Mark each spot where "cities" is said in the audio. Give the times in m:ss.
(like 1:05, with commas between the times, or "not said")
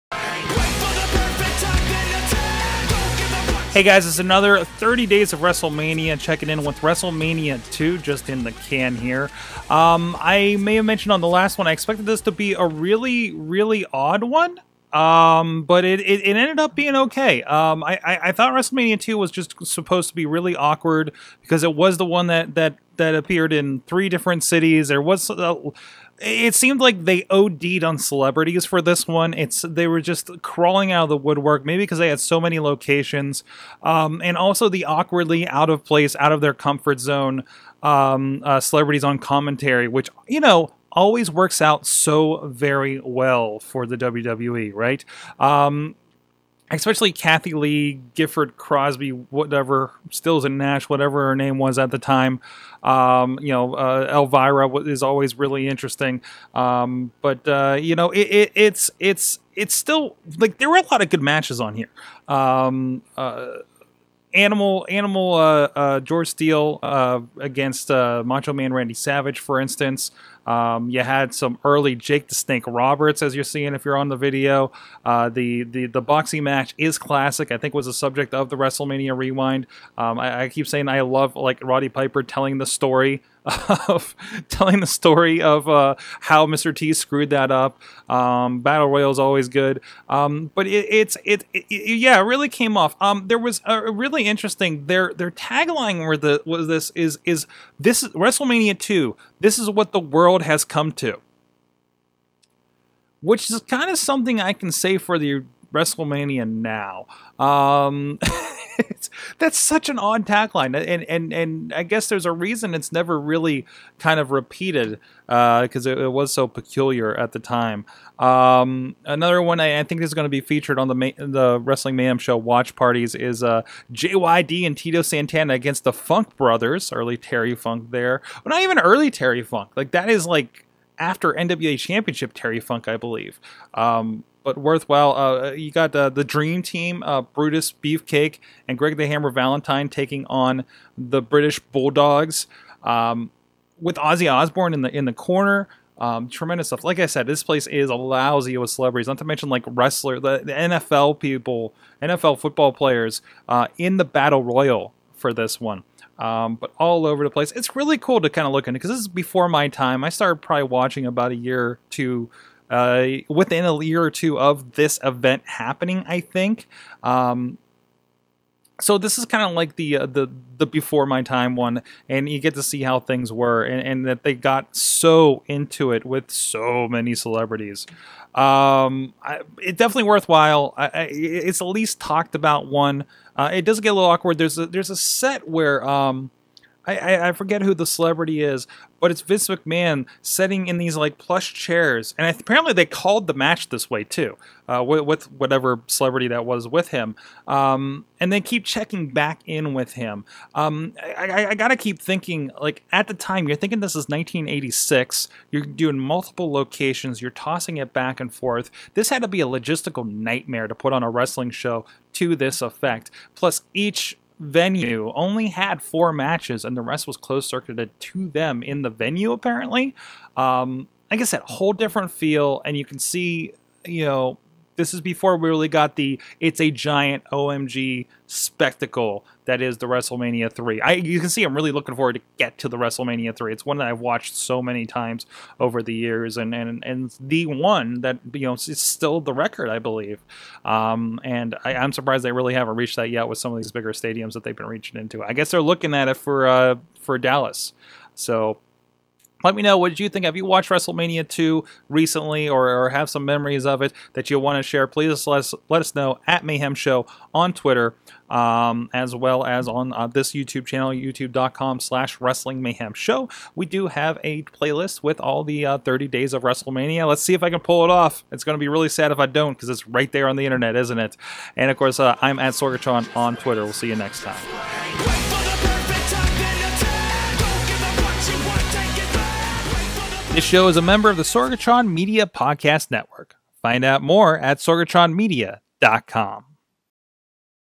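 0:24.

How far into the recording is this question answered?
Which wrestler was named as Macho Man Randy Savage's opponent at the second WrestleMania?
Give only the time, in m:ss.
1:05.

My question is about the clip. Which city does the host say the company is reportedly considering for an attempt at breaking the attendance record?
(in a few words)
Dallas.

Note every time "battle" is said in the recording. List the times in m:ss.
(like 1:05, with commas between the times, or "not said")
1:28, 2:34.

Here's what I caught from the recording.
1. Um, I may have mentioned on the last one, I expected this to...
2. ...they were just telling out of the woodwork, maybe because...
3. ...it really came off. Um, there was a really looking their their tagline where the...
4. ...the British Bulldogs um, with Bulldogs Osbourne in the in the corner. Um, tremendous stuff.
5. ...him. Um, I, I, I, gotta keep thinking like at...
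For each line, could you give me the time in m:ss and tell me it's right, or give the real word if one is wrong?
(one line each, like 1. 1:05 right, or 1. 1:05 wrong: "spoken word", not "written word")
1. 0:09 right
2. 0:29 wrong: "crawling", not "telling"
3. 1:32 wrong: "interesting", not "looking"
4. 2:20 wrong: "Ozzy", not "Bulldogs"
5. 3:19 right.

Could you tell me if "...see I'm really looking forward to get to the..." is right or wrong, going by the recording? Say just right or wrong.
right.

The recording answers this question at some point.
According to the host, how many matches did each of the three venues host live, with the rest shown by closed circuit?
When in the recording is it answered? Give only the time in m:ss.
3:35.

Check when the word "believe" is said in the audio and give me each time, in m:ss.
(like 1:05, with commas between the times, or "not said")
2:12, 3:59.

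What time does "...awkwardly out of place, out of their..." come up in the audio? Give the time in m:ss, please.
0:34.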